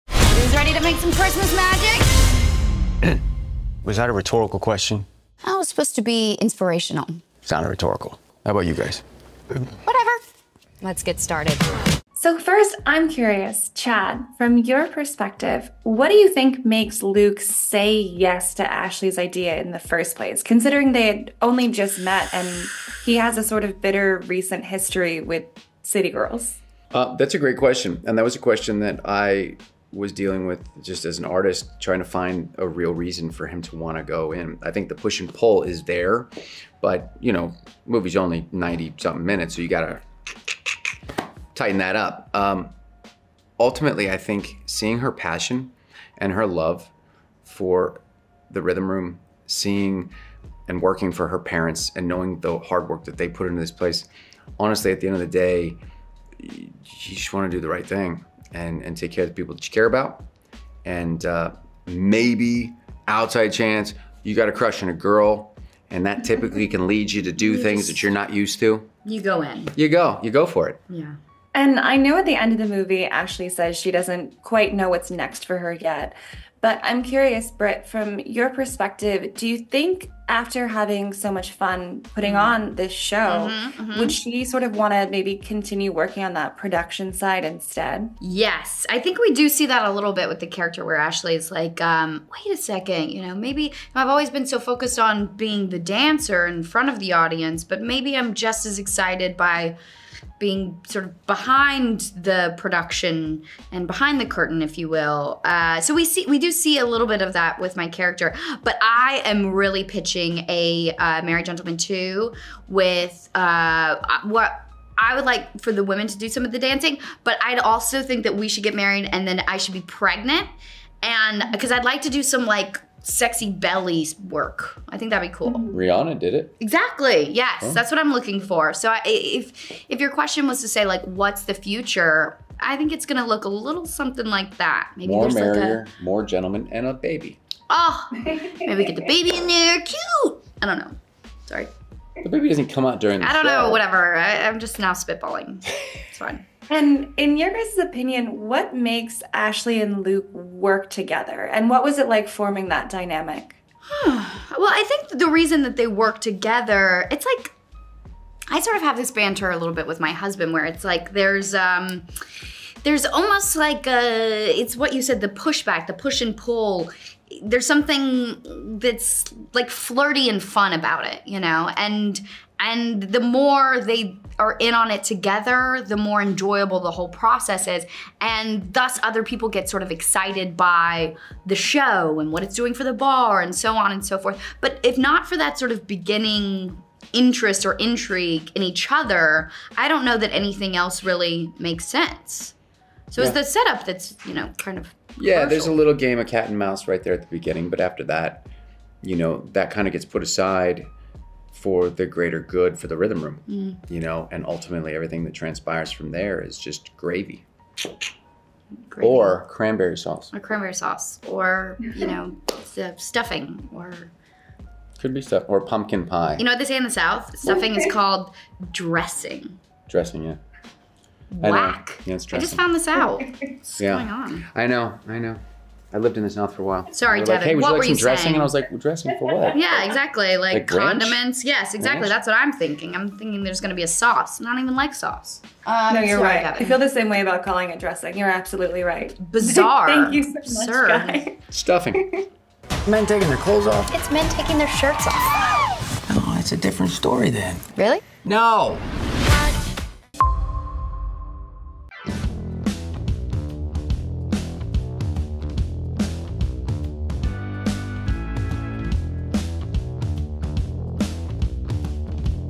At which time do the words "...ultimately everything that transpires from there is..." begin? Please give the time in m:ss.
3:24.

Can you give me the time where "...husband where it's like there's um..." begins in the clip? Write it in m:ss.
2:40.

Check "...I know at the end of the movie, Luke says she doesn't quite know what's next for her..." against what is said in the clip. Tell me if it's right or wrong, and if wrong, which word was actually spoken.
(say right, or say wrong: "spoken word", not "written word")
wrong: "Ashley", not "Luke".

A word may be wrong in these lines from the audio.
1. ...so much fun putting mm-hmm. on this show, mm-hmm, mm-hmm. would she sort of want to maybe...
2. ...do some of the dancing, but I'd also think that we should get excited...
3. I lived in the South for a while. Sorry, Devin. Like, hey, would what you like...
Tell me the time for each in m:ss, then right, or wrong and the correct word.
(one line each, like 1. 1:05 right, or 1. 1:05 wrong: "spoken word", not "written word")
1. 1:21 right
2. 1:56 wrong: "married", not "excited"
3. 3:45 right.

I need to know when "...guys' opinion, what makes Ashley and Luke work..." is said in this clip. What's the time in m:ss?
2:27.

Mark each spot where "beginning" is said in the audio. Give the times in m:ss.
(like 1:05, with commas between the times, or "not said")
3:05, 3:17.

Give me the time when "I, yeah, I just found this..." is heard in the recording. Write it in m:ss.
3:42.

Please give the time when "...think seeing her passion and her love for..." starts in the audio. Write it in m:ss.
0:44.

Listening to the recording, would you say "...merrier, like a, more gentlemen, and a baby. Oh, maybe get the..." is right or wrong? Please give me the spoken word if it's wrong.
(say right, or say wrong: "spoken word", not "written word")
right.